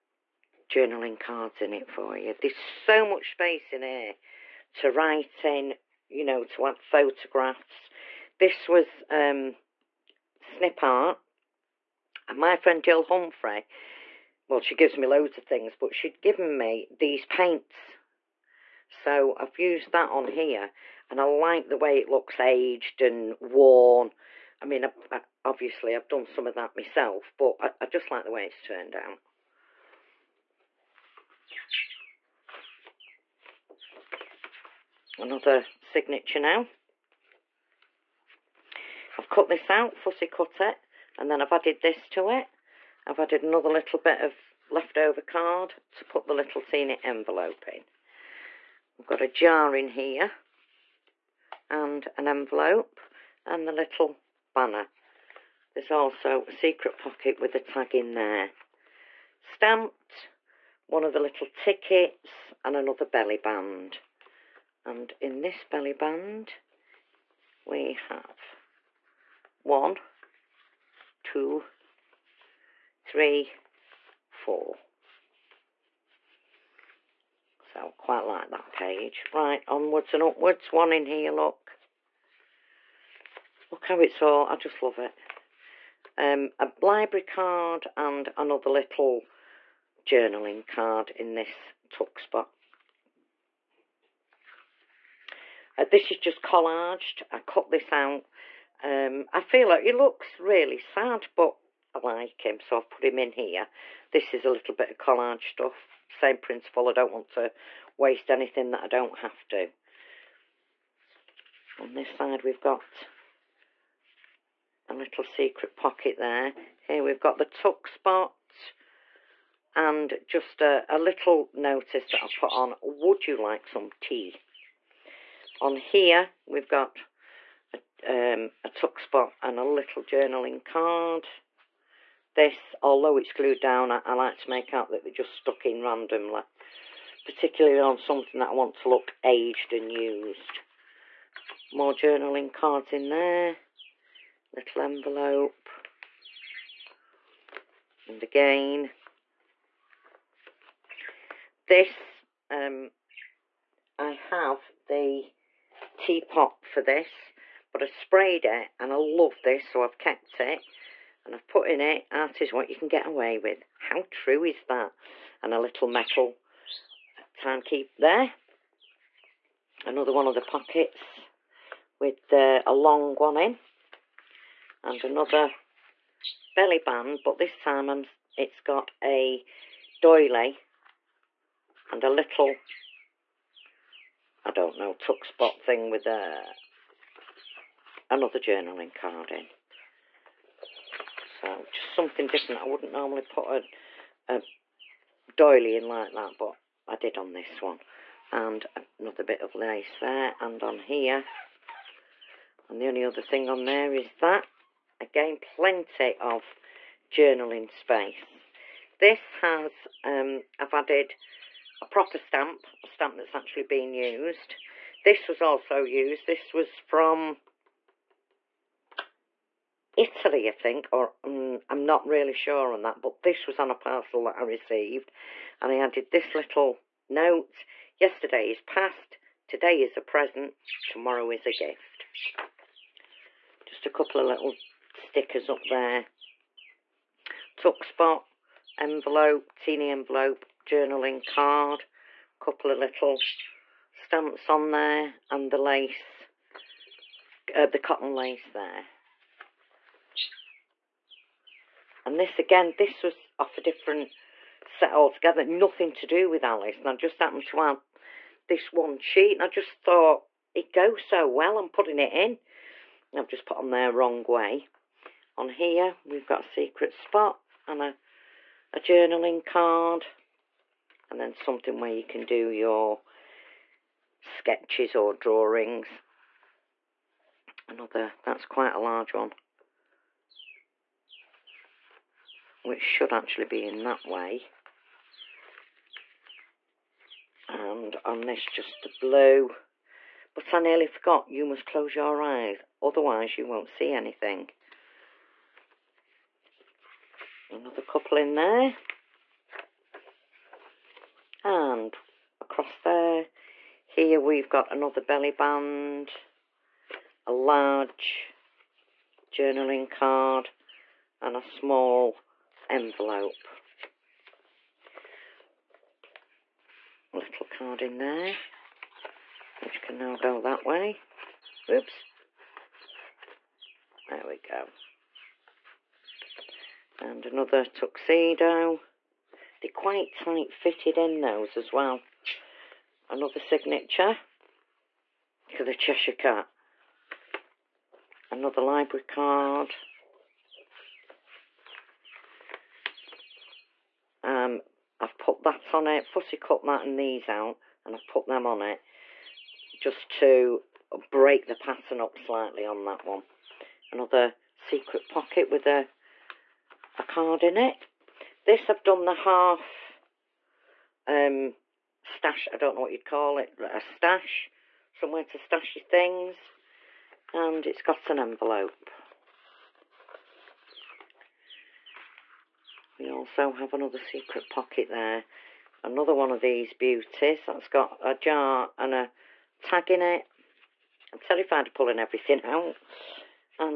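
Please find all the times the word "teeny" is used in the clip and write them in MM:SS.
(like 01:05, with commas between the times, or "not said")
00:46, 03:59.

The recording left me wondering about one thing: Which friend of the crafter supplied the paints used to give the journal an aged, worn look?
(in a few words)
Jill Humphrey.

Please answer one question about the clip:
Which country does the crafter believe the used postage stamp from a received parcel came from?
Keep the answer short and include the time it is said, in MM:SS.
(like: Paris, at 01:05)
Italy, at 03:39.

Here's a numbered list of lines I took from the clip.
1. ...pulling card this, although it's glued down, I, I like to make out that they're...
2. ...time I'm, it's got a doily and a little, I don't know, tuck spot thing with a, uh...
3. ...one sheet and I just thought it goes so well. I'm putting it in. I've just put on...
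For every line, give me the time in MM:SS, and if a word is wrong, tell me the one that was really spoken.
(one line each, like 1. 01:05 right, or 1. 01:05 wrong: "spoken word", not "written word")
1. 02:10 wrong: "journaling", not "pulling"
2. 02:57 right
3. 04:18 right.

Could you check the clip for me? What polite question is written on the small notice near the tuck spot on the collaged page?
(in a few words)
Would you like some tea?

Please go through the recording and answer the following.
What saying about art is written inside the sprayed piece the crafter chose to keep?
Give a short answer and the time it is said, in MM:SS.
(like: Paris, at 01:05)
Art is what you can get away with, at 02:42.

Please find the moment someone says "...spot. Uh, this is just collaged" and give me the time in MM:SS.
01:32.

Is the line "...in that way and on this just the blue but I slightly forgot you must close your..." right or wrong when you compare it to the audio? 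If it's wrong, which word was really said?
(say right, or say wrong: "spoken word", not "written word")
wrong: "nearly", not "slightly".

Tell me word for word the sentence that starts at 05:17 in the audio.
Little card in there, which can now go that way.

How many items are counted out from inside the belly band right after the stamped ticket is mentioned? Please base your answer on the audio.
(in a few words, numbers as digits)
4.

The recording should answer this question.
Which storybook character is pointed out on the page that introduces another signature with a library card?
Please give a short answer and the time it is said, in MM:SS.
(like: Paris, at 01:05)
Cheshire Cat, at 05:35.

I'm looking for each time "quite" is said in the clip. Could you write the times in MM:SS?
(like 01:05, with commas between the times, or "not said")
01:17, 04:38, 05:29.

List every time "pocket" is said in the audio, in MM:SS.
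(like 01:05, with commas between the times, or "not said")
00:56, 01:55, 02:50, 05:55, 06:14.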